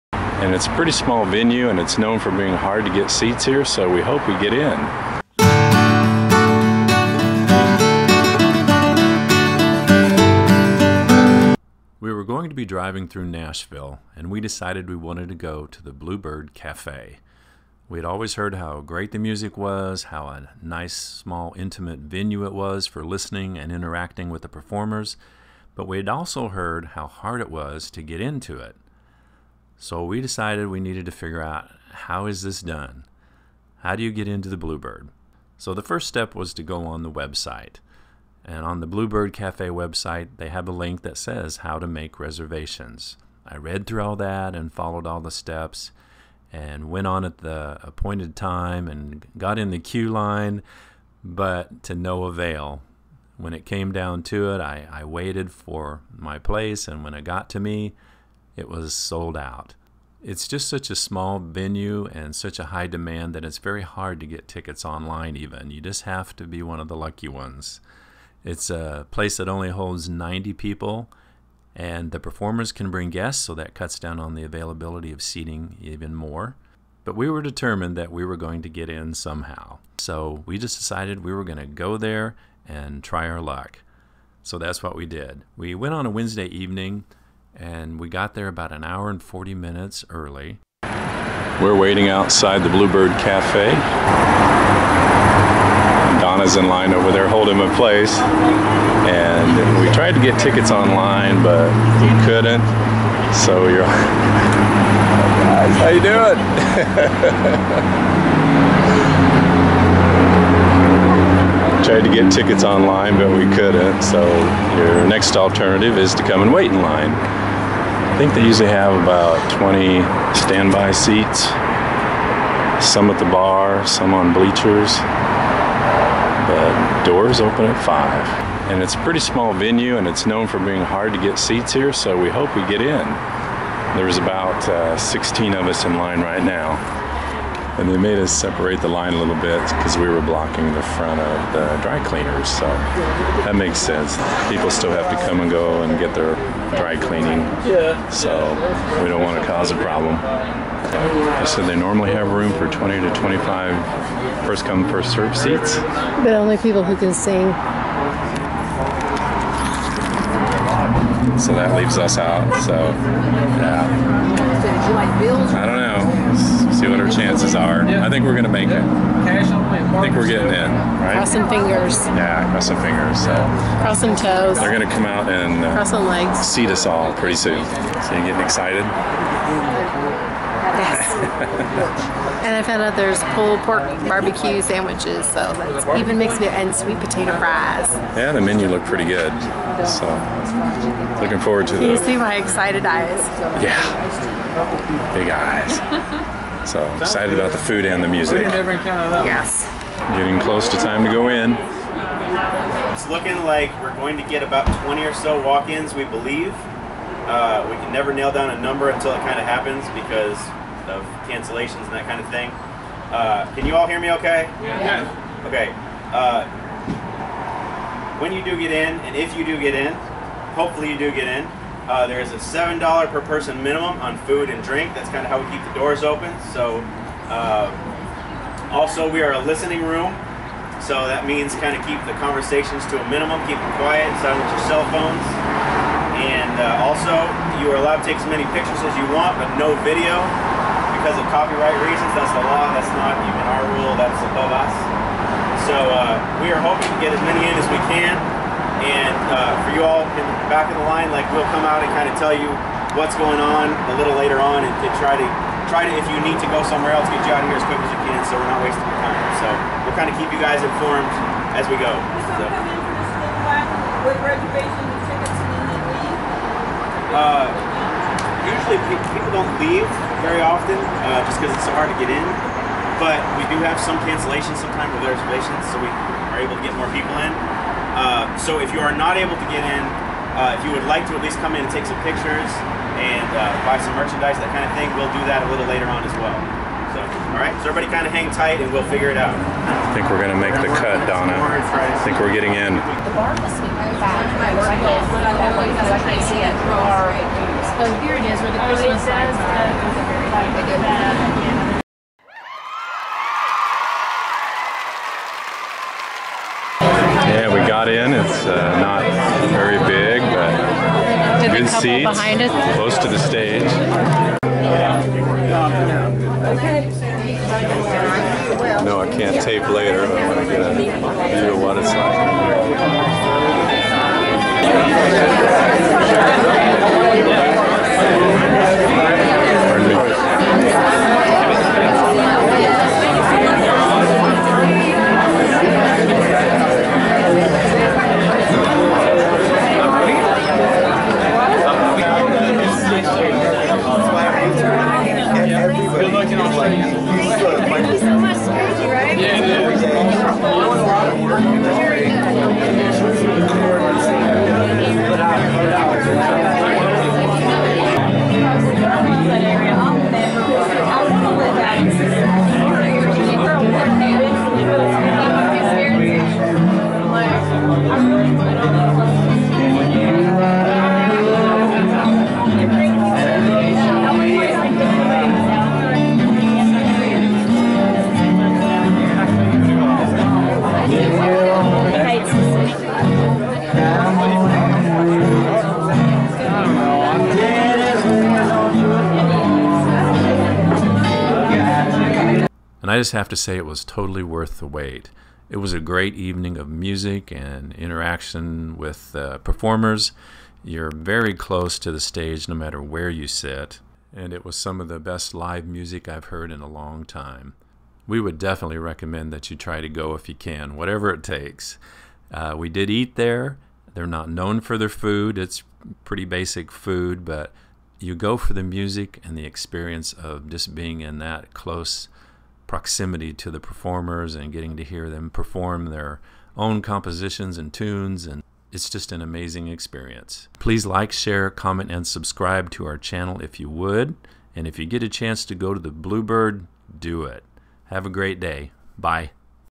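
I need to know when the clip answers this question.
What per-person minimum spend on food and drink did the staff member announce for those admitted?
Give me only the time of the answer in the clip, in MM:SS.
03:42.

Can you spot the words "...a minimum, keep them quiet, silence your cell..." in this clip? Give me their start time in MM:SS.
03:52.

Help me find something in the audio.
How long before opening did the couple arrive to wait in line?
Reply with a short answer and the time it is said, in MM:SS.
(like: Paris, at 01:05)
an hour and 40 minutes, at 01:28.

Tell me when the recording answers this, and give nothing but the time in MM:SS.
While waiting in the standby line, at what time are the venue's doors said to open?
02:07.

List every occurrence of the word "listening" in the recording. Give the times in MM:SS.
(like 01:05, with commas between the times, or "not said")
00:23, 03:49.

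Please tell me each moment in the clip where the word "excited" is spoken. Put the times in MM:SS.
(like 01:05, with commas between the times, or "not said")
02:58, 03:12, 03:16.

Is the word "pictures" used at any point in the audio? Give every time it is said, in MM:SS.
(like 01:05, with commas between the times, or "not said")
03:58, 04:42.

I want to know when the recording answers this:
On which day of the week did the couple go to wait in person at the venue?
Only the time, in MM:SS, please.
01:26.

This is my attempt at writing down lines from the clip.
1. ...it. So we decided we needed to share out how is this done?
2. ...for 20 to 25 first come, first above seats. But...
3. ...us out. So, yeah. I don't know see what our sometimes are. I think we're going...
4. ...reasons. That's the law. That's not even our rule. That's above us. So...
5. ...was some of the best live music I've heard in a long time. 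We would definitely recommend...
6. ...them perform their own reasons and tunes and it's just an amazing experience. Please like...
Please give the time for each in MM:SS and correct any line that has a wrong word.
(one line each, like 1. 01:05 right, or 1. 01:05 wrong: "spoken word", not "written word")
1. 00:28 wrong: "figure", not "share"
2. 02:32 wrong: "serve", not "above"
3. 02:41 wrong: "chances", not "sometimes"
4. 04:01 right
5. 06:44 right
6. 07:05 wrong: "compositions", not "reasons".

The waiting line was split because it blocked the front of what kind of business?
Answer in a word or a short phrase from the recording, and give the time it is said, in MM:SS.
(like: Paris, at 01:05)
dry cleaners, at 02:21.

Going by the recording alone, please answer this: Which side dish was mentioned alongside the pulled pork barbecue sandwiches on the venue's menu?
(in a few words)
sweet potato fries.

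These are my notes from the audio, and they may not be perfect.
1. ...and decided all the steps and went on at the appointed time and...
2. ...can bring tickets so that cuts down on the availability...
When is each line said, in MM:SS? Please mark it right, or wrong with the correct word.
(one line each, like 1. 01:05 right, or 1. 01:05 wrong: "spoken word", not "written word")
1. 00:44 wrong: "followed", not "decided"
2. 01:12 wrong: "guests", not "tickets".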